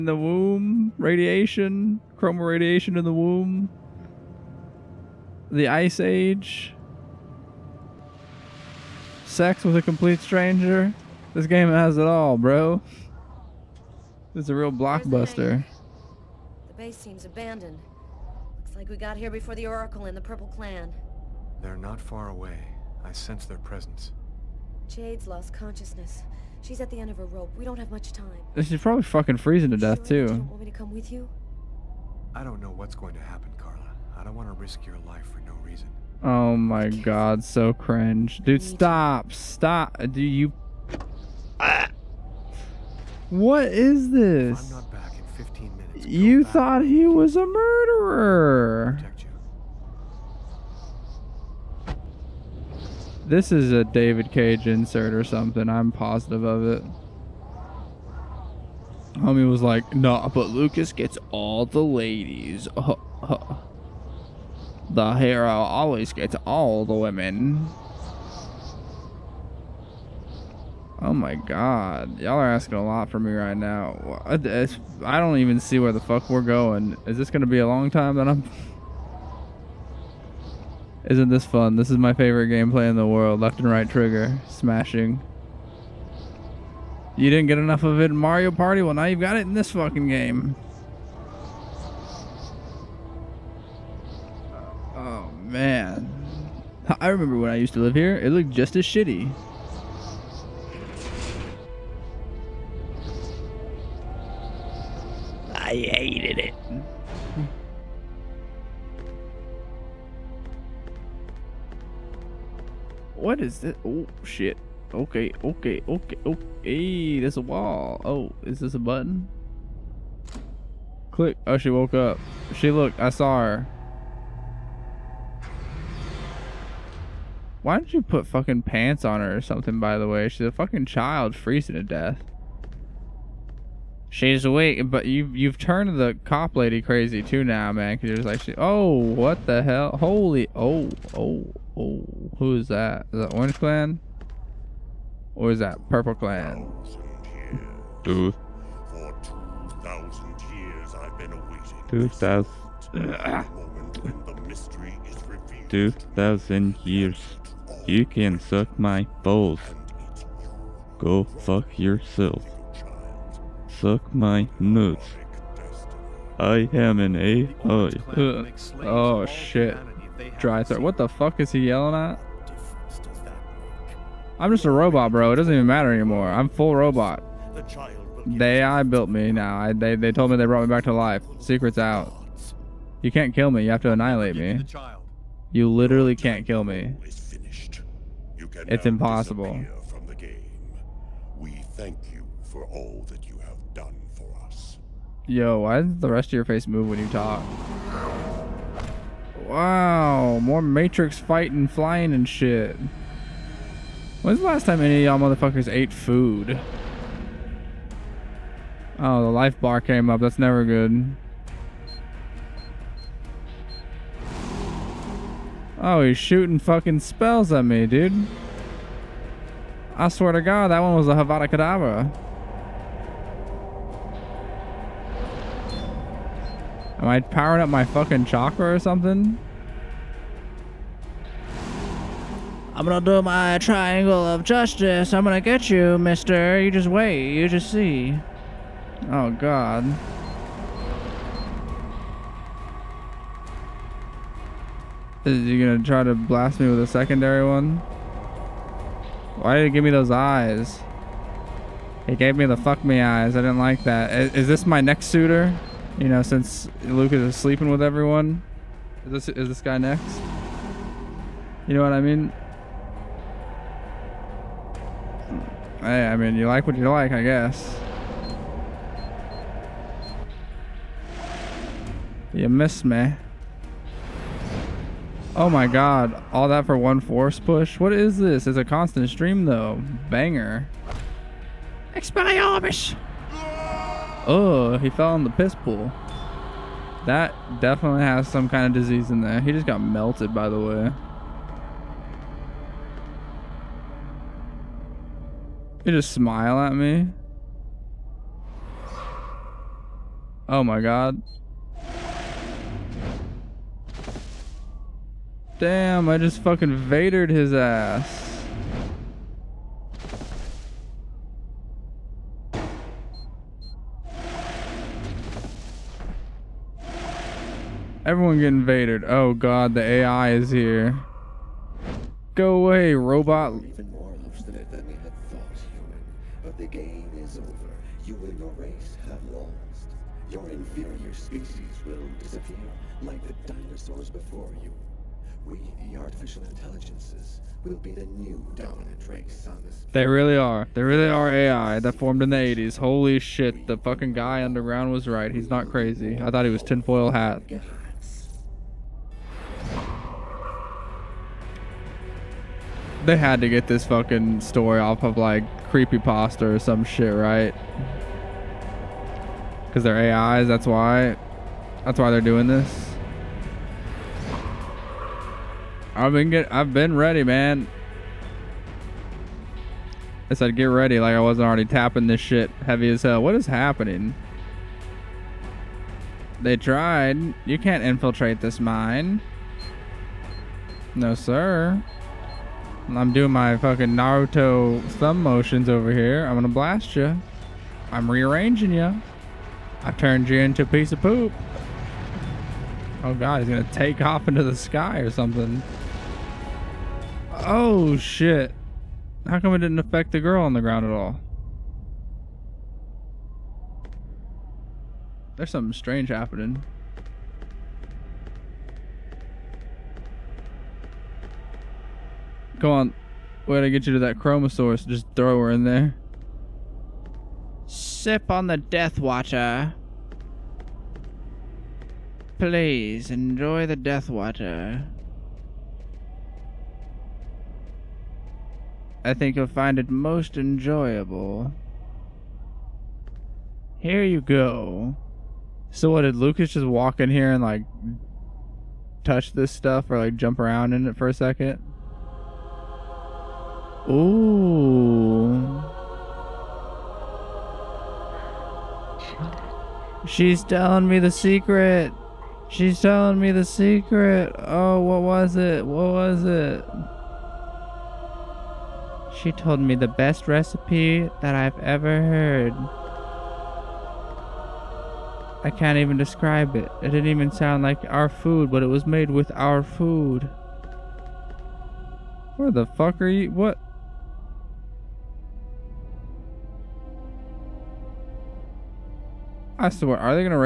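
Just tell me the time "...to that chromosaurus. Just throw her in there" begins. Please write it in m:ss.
6:53.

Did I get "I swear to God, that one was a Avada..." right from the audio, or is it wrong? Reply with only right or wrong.
right.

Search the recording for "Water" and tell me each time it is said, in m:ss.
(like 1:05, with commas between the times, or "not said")
6:58, 7:04.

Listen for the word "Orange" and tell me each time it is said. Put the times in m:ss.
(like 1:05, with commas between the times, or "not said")
2:23.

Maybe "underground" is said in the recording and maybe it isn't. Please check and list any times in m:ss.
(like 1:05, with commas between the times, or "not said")
5:44.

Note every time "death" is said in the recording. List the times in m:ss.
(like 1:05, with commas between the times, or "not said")
0:29, 2:11, 6:58, 7:03.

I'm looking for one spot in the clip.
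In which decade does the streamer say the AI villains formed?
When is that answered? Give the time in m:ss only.
5:42.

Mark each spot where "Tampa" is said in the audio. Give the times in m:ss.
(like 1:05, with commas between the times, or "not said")
not said.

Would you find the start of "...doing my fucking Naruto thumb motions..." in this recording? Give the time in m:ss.
6:23.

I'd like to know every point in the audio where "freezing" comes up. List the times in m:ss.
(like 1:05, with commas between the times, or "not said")
0:29, 2:11.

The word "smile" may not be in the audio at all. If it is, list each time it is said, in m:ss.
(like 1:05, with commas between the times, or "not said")
4:56.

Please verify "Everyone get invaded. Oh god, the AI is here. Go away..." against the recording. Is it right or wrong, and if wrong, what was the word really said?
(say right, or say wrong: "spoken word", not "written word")
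right.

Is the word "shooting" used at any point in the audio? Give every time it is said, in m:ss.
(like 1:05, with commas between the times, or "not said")
3:36.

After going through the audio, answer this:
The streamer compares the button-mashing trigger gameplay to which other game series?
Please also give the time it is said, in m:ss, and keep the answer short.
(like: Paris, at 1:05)
Mario Party, at 1:28.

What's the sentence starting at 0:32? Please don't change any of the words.
I don't know what's going to happen, Carla.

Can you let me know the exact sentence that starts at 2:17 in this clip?
Cause you're just like, she, oh, what the hell?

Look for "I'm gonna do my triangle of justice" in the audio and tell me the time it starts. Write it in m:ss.
3:52.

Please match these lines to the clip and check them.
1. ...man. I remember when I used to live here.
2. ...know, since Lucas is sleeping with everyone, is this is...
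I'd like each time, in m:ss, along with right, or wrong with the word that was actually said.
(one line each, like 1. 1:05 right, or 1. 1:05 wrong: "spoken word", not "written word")
1. 1:35 right
2. 4:16 right.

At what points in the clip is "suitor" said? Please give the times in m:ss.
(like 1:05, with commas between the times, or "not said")
4:15.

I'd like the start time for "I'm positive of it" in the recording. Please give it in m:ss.
0:55.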